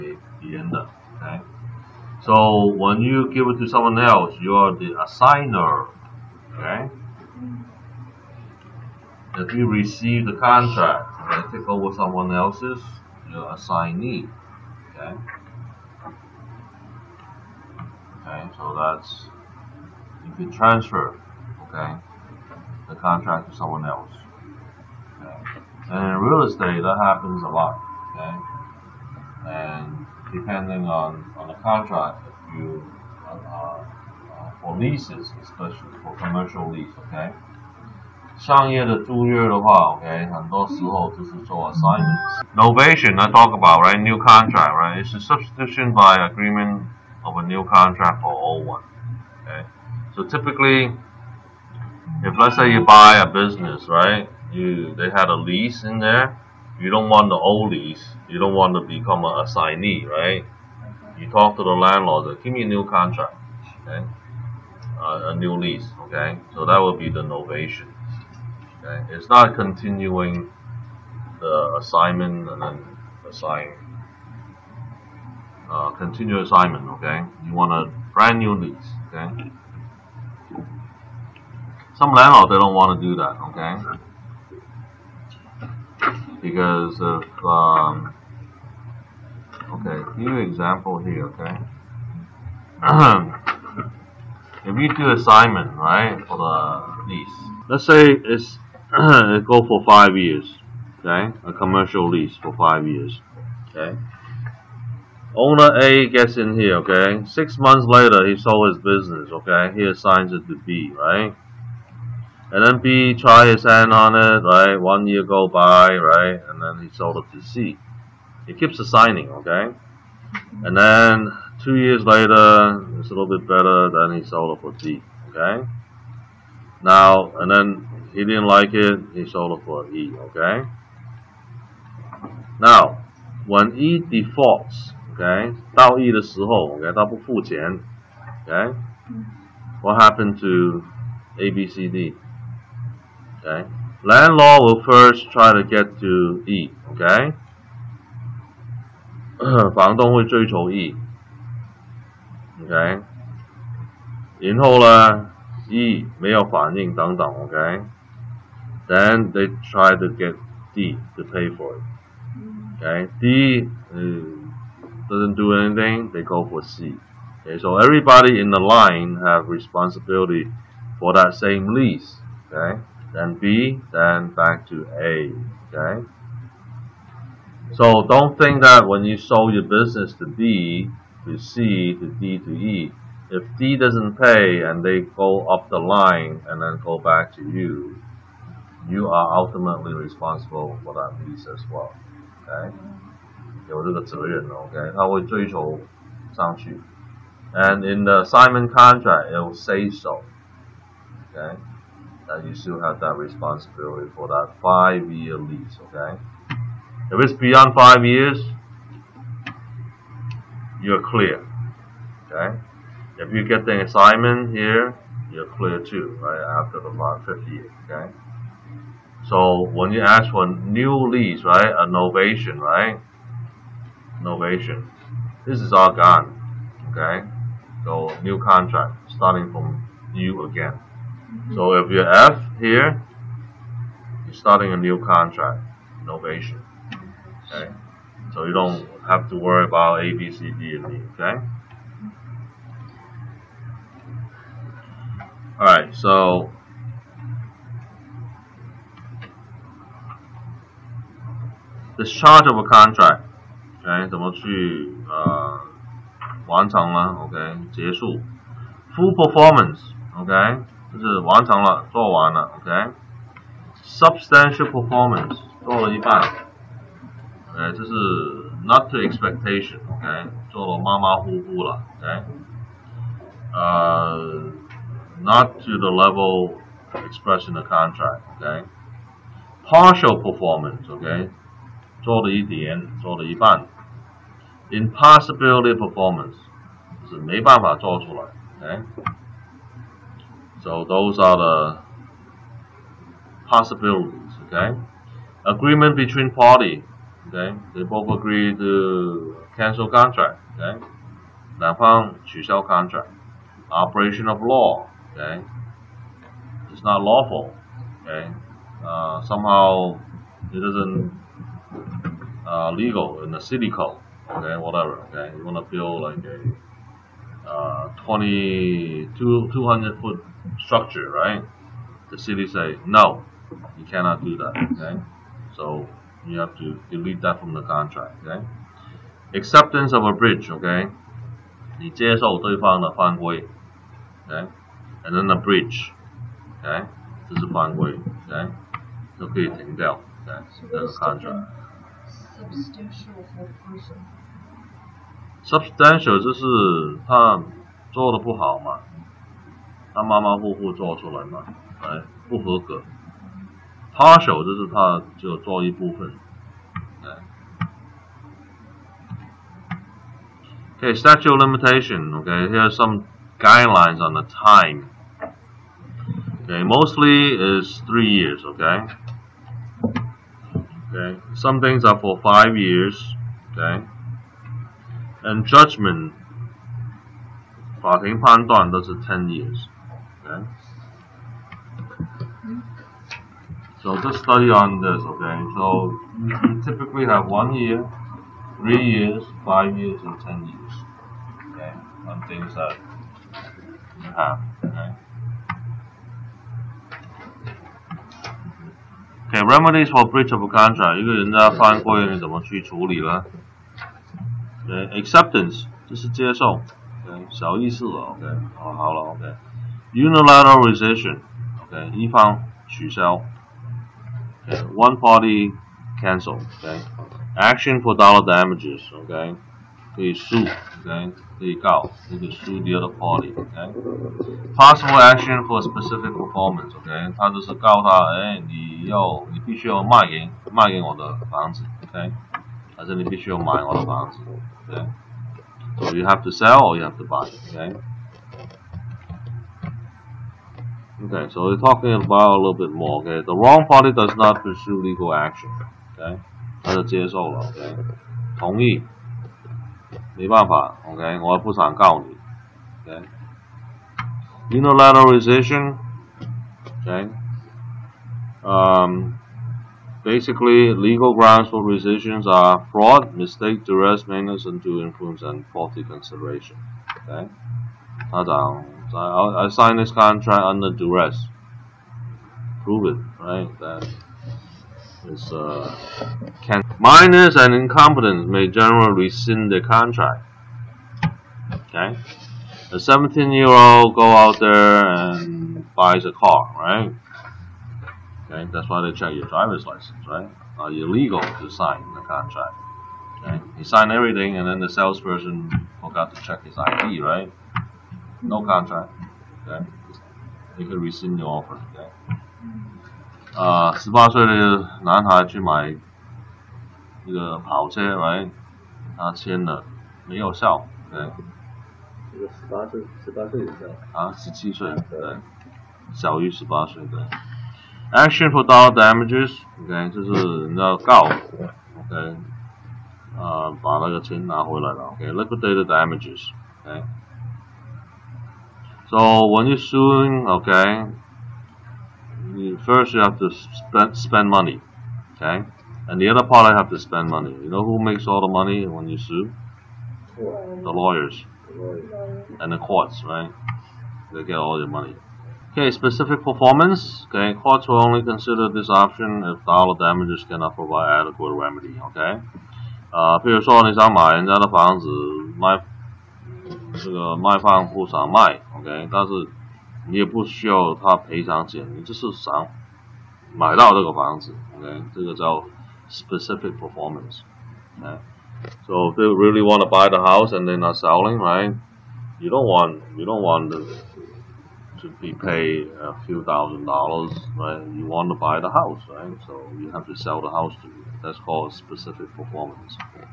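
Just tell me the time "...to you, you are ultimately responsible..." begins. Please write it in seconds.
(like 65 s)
187 s.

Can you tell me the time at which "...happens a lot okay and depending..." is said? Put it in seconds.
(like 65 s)
27 s.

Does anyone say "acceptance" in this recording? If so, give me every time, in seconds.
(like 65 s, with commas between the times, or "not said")
329 s, 404 s.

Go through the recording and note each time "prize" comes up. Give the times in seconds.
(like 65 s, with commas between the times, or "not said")
not said.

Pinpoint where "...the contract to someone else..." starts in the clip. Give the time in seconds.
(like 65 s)
22 s.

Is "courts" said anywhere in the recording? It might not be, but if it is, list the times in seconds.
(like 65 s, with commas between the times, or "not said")
542 s, 547 s.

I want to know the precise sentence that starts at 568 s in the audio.
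So if you really want to buy the house and then are not selling, right?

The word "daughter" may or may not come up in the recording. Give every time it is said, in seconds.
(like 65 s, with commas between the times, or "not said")
not said.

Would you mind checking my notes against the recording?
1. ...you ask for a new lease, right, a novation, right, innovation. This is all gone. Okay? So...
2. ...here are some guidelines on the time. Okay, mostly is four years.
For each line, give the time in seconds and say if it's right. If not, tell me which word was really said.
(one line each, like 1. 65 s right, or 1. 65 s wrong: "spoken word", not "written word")
1. 219 s right
2. 362 s wrong: "three", not "four".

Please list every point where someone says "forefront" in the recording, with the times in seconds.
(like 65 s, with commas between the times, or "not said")
not said.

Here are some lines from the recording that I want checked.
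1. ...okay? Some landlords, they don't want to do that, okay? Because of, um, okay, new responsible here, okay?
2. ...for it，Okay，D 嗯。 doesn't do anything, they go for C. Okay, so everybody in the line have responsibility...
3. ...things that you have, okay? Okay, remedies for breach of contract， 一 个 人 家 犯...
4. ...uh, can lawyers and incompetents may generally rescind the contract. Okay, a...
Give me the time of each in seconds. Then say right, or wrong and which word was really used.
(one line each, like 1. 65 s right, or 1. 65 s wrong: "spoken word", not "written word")
1. 79 s wrong: "example", not "responsible"
2. 161 s right
3. 392 s right
4. 475 s wrong: "minors", not "lawyers".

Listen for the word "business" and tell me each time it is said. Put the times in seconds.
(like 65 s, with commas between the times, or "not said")
53 s, 108 s, 179 s.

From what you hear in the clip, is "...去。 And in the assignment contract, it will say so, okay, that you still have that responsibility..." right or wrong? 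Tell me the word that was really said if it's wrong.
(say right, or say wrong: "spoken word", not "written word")
right.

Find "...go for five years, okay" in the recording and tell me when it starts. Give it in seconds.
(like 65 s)
99 s.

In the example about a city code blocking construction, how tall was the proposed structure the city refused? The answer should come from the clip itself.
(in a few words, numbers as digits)
200 foot.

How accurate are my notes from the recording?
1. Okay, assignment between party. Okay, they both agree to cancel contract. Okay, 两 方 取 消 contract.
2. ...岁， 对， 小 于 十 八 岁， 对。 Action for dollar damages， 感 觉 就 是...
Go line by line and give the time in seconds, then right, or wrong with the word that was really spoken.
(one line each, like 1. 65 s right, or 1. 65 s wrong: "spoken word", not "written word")
1. 294 s wrong: "agreement", not "assignment"
2. 514 s right.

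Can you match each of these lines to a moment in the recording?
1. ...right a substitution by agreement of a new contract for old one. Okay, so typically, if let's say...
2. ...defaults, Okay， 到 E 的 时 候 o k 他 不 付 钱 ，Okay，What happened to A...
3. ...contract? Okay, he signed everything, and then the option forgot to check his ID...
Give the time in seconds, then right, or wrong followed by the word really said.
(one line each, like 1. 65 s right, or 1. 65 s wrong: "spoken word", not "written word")
1. 44 s right
2. 133 s right
3. 492 s wrong: "salesperson", not "option".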